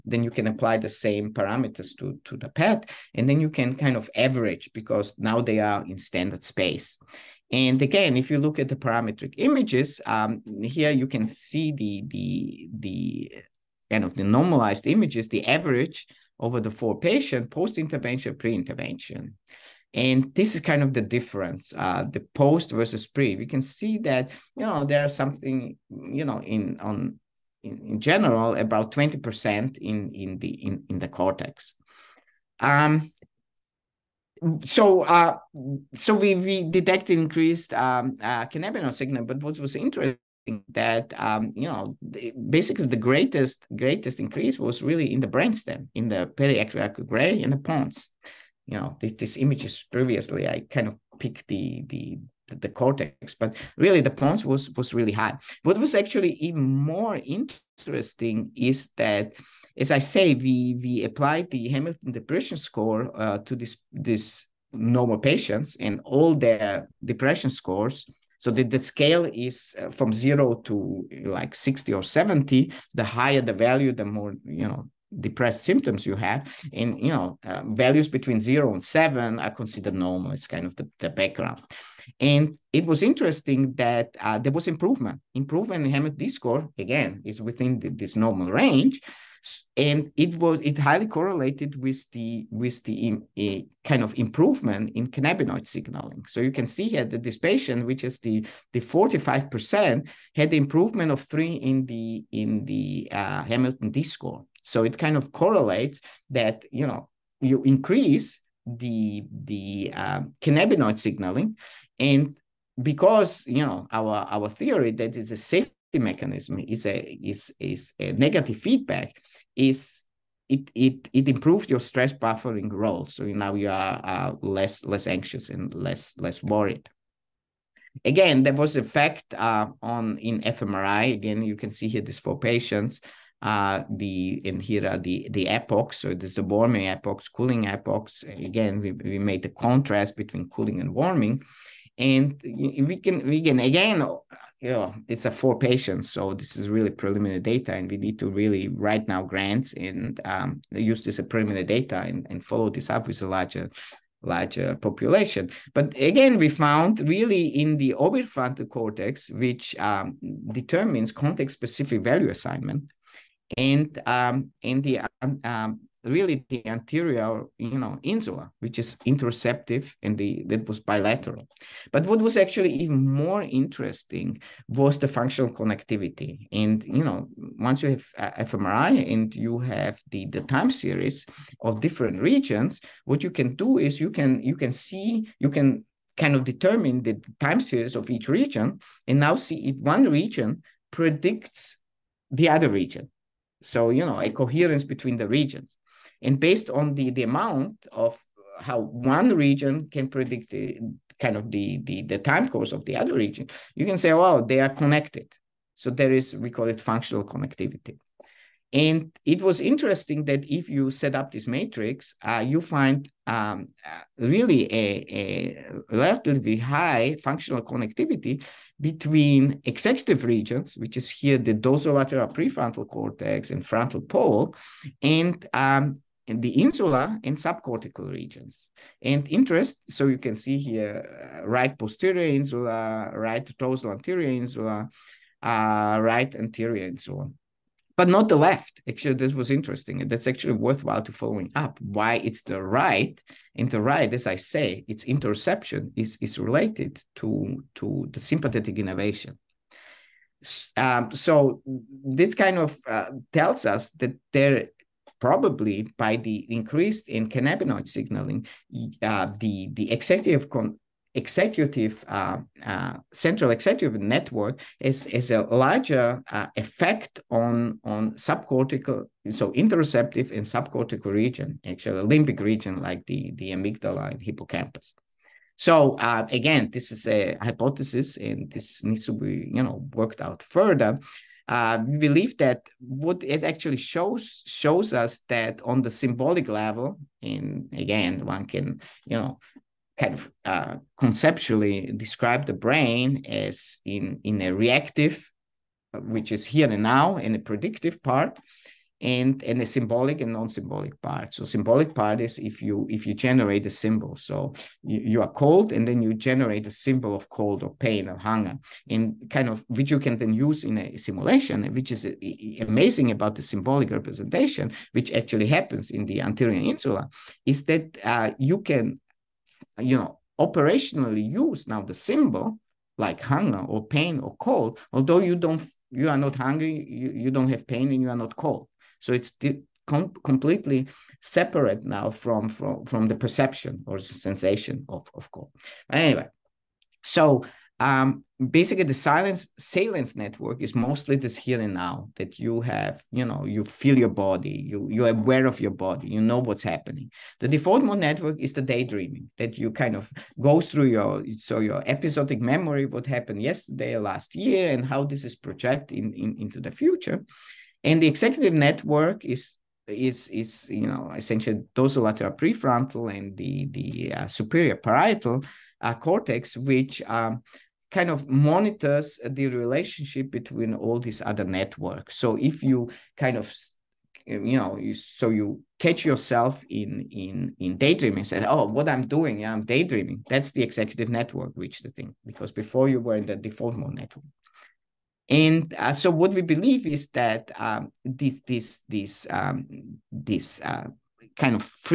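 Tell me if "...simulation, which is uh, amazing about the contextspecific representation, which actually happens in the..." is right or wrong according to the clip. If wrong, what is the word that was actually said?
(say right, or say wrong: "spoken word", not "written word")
wrong: "symbolic", not "contextspecific".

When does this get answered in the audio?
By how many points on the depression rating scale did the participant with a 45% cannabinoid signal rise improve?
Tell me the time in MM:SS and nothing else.
01:41.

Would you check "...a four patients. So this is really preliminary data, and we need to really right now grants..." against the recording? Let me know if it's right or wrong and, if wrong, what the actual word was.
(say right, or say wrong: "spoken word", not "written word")
right.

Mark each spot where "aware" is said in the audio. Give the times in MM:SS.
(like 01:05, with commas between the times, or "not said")
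05:45.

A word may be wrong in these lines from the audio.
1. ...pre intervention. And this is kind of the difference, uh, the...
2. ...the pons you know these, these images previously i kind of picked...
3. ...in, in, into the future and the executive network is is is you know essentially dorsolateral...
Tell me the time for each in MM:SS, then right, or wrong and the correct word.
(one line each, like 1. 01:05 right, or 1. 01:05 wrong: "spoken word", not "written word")
1. 00:18 right
2. 00:47 right
3. 05:55 right.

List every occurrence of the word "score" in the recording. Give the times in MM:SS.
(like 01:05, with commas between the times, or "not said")
01:02, 01:07, 01:26, 01:44.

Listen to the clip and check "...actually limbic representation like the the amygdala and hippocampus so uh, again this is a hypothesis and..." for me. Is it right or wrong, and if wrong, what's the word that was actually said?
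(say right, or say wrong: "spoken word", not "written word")
wrong: "region", not "representation".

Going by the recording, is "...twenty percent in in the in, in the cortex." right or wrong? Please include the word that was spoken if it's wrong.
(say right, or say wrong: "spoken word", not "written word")
right.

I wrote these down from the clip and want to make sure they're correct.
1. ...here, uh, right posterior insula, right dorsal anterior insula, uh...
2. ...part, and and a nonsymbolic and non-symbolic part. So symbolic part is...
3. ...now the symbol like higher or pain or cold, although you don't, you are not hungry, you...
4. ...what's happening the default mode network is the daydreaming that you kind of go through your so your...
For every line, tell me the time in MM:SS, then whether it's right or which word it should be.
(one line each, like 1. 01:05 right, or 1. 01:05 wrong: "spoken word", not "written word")
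1. 03:50 right
2. 04:58 wrong: "symbolic", not "nonsymbolic"
3. 05:21 wrong: "hunger", not "higher"
4. 05:46 right.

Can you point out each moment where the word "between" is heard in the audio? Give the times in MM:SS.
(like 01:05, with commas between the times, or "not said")
01:18, 02:20, 03:14, 03:38, 06:10.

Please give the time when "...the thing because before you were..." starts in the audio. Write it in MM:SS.
06:21.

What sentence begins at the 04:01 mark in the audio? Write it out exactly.
Why it's the right, and the right, as I say, its interoception is is related to to the sympathetic innervation.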